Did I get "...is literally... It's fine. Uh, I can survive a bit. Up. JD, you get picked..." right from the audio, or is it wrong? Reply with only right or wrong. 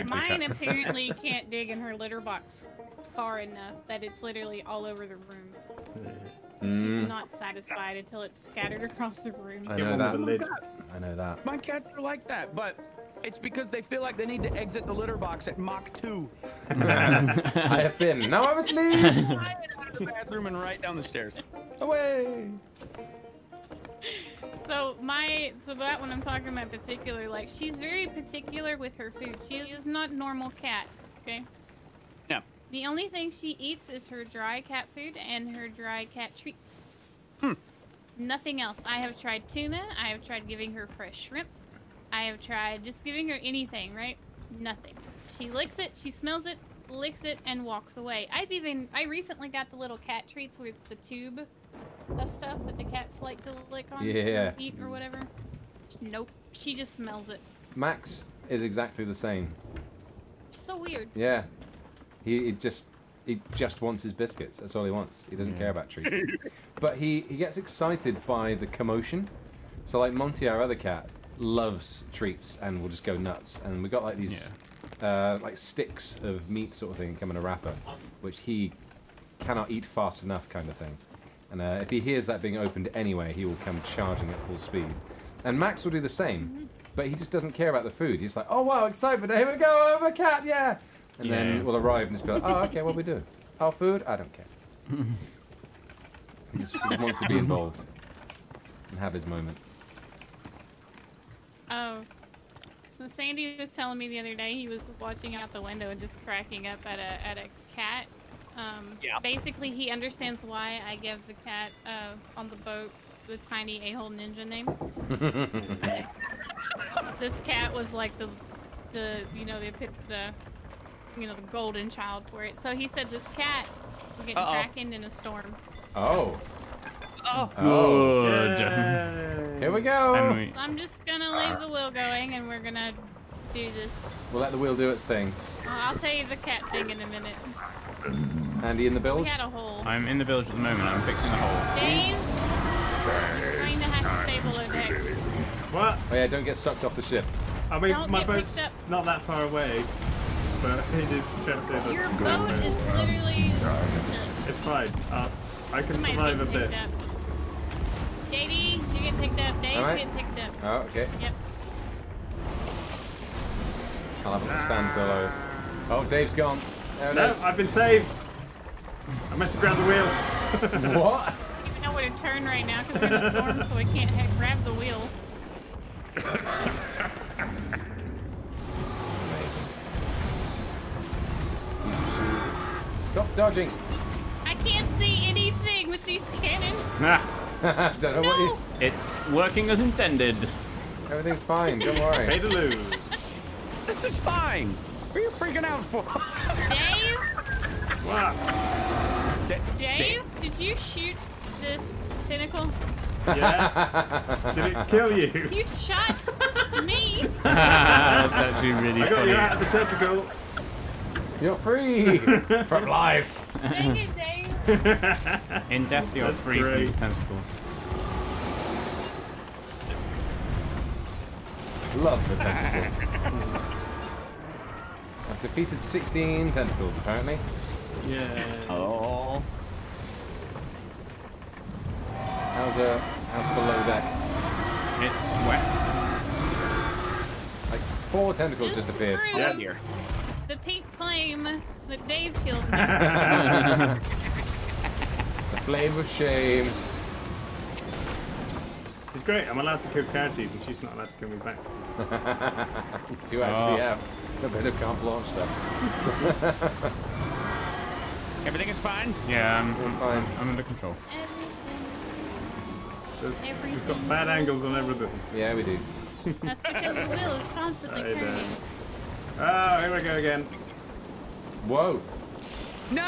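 right.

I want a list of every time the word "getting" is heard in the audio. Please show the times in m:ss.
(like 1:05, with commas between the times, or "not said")
2:04, 2:39.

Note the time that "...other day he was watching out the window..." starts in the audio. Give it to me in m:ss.
1:44.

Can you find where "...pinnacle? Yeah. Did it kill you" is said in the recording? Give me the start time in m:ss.
3:22.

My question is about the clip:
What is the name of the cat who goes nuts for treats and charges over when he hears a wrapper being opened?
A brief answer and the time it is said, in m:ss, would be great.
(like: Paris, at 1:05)
Monty, at 1:10.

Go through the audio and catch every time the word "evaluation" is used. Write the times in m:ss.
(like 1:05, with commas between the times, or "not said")
not said.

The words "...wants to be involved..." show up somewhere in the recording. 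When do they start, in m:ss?
1:36.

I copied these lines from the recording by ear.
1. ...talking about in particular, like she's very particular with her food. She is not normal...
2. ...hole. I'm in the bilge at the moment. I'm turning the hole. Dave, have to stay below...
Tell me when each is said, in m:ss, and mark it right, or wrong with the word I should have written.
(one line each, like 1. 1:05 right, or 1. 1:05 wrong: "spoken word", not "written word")
1. 0:26 right
2. 2:19 wrong: "fixing", not "turning".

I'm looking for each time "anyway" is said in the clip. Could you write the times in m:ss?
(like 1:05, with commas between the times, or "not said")
1:22.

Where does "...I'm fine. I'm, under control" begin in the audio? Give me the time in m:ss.
4:19.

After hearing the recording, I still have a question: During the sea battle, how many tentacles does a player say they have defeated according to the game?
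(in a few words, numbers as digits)
16.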